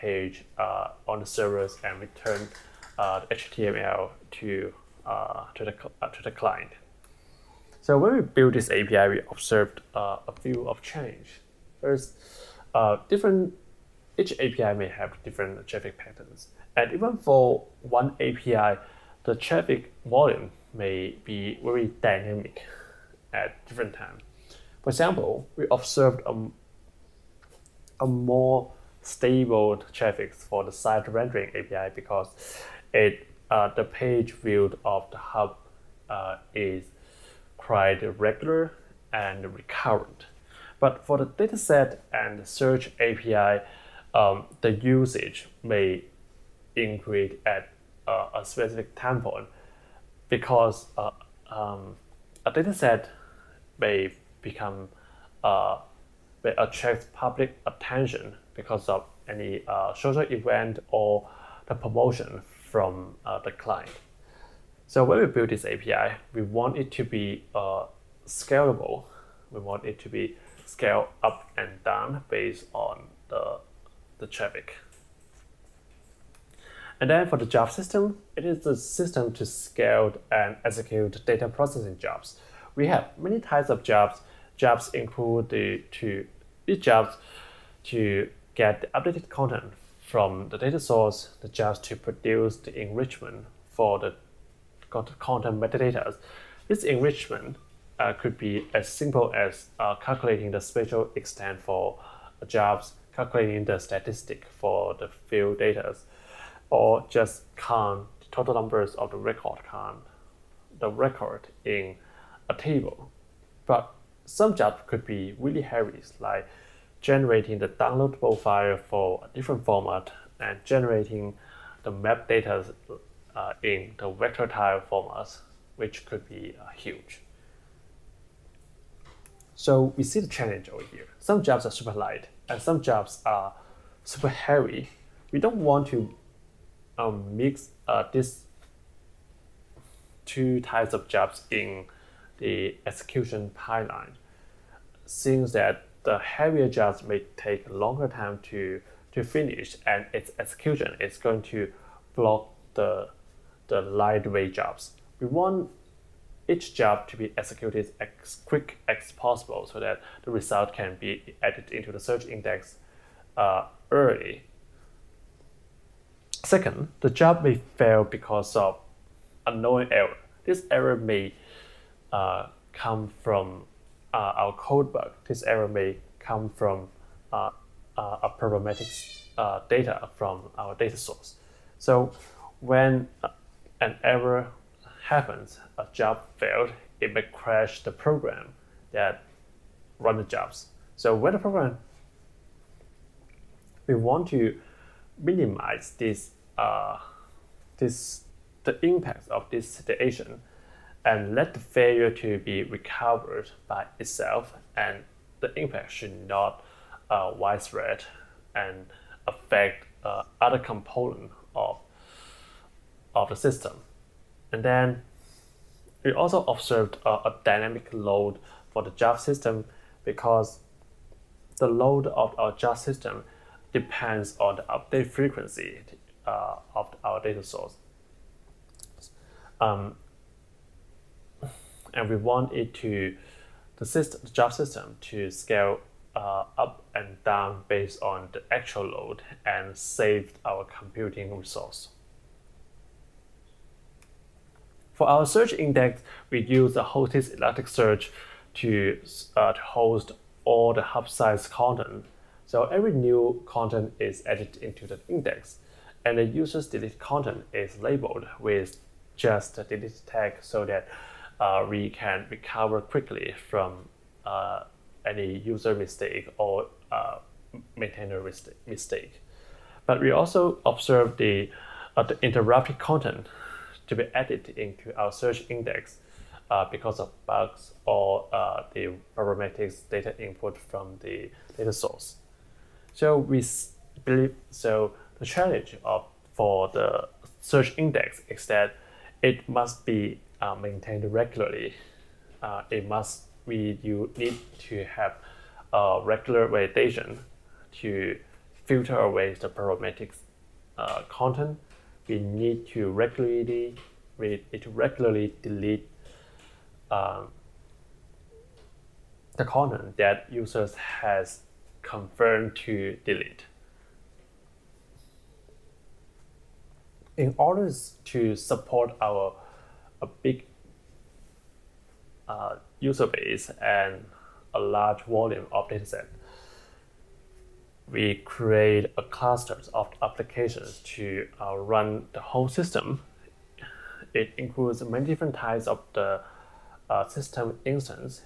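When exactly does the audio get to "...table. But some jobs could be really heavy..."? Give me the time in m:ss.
1:52.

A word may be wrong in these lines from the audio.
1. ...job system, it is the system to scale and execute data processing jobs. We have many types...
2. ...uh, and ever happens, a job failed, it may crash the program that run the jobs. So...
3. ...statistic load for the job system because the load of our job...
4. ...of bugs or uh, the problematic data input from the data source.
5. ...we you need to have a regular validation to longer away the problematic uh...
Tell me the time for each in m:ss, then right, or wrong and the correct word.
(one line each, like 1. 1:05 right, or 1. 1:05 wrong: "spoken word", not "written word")
1. 1:17 right
2. 3:03 right
3. 3:37 wrong: "dynamic", not "statistic"
4. 4:36 right
5. 4:53 wrong: "filter", not "longer".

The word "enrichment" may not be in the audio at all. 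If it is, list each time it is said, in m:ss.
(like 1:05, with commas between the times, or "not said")
1:32, 1:36.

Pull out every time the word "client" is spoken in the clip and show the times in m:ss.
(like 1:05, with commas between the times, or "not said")
0:06, 1:03.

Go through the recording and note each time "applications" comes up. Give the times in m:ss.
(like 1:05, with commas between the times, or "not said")
5:30.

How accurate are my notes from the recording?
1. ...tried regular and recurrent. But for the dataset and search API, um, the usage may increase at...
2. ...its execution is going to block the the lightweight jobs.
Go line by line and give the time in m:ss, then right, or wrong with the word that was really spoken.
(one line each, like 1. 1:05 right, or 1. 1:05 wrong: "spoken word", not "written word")
1. 0:37 right
2. 2:30 right.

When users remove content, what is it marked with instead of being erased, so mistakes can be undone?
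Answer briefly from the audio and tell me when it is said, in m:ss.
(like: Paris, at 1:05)
delete tag, at 4:19.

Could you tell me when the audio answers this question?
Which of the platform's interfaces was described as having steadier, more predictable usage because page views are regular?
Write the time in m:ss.
0:30.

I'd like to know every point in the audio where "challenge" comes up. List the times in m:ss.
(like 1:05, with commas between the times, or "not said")
2:10, 4:45.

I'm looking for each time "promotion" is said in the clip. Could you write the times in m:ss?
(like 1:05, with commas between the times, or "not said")
1:01.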